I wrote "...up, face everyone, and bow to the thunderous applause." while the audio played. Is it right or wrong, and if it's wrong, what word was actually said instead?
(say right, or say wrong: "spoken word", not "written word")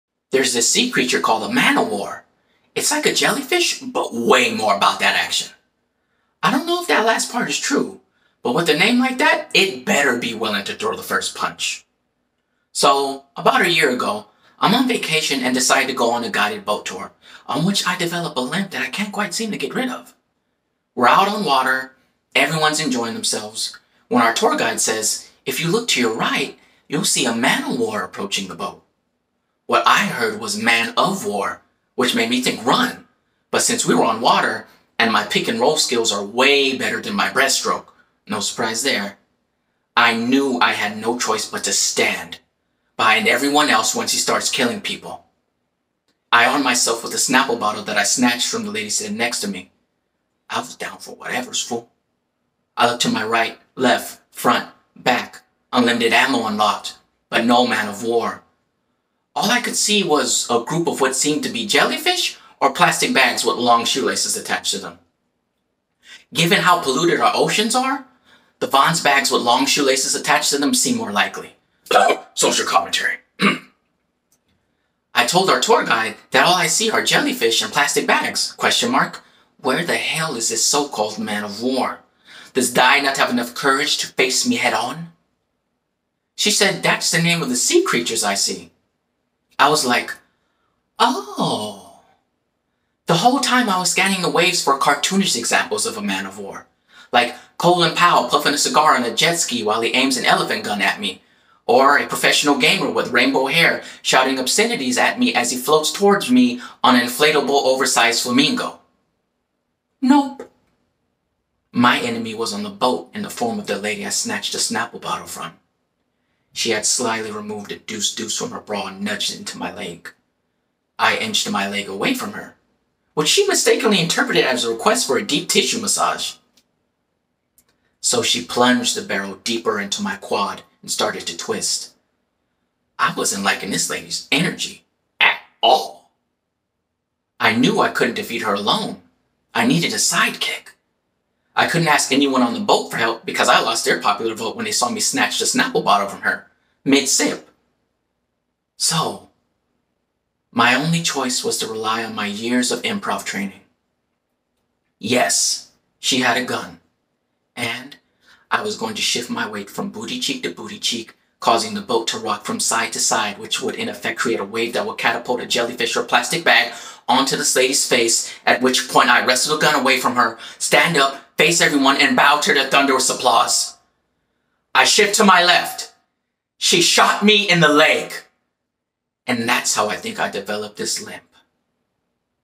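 right.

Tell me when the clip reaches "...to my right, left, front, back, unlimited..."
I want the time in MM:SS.
00:53.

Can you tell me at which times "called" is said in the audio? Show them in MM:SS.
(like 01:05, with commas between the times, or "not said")
00:01, 01:20.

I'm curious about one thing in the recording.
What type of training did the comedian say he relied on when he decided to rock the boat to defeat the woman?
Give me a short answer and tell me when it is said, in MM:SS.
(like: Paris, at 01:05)
improv, at 02:32.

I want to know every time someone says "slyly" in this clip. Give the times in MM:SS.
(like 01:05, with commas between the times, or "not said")
01:56.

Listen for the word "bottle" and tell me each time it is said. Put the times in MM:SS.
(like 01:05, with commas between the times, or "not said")
00:47, 01:55, 02:25.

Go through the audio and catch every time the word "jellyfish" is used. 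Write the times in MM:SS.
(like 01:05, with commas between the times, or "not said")
00:03, 01:01, 01:17, 02:45.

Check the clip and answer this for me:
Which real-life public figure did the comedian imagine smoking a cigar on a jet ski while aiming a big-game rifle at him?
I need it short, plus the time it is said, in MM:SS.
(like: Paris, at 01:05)
Colin Powell, at 01:37.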